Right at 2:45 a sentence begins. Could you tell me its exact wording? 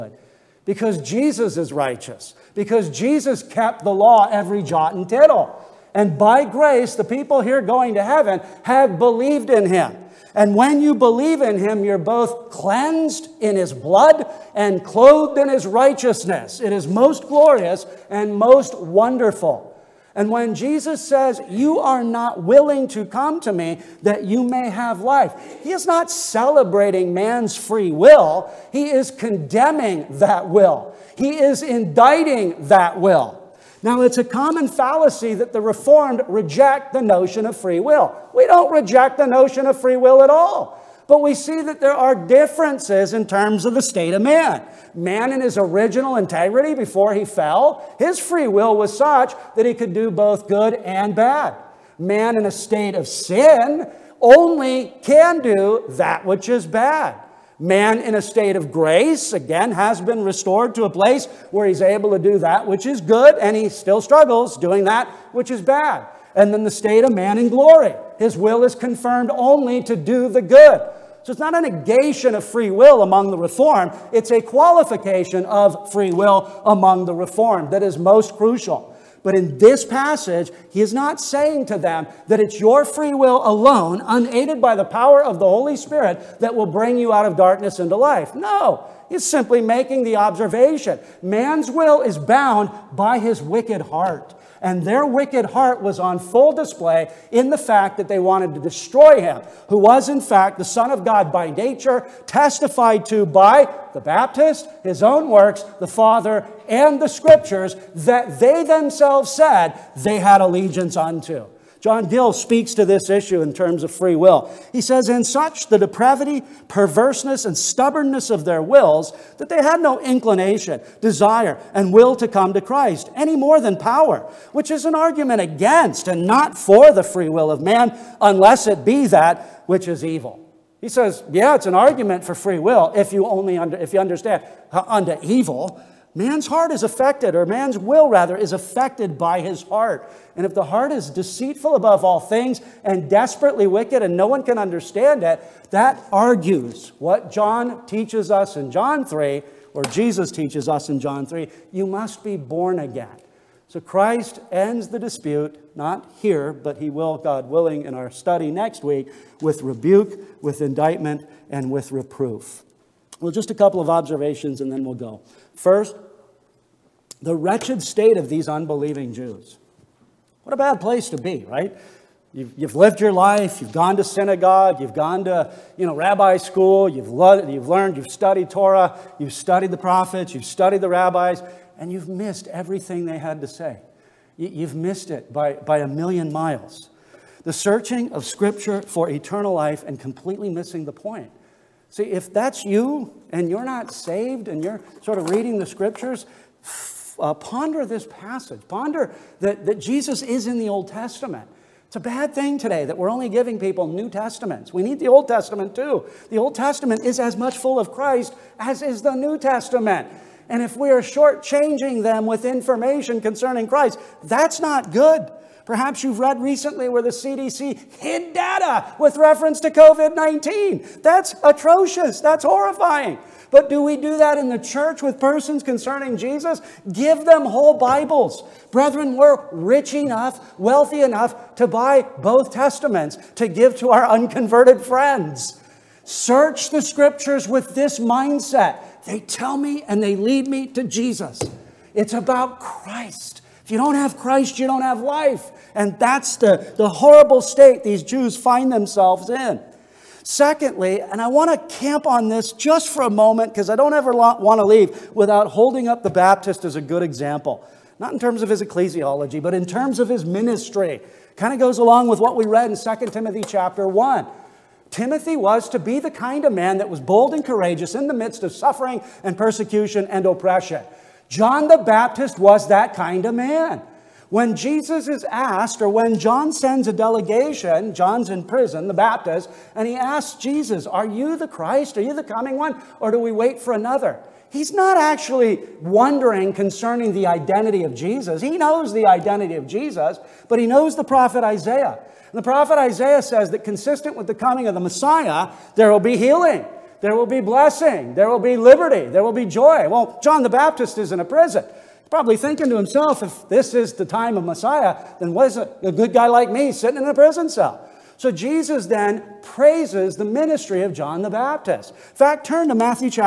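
First, the wretched state of these unbelieving Jews.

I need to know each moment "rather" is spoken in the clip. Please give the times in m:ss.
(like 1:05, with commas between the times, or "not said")
2:18.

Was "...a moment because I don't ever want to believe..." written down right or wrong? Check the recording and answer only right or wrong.
wrong.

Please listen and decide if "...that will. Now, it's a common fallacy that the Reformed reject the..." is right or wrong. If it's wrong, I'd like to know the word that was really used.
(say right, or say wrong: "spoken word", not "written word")
right.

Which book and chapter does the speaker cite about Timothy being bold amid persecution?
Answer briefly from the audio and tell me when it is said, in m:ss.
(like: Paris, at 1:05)
2 Timothy chapter 1, at 4:22.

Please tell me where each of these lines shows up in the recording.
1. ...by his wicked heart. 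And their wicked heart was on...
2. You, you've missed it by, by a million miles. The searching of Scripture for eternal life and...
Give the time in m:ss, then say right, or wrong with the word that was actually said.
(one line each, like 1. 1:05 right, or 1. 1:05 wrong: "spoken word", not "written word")
1. 1:32 right
2. 3:04 right.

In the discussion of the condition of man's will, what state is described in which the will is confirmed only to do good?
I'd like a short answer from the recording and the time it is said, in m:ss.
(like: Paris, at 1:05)
glory, at 1:07.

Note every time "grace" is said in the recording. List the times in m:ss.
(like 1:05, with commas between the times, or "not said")
0:06, 0:58.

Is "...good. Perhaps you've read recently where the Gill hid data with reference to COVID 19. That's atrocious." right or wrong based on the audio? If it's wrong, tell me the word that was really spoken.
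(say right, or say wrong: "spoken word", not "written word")
wrong: "CDC", not "Gill".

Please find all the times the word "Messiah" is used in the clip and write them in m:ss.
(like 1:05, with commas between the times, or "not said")
4:54, 5:04.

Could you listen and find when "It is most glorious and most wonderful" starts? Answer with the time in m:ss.
0:16.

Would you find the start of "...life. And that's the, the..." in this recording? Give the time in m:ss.
4:05.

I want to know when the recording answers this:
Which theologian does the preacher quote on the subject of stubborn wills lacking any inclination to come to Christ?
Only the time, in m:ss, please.
1:51.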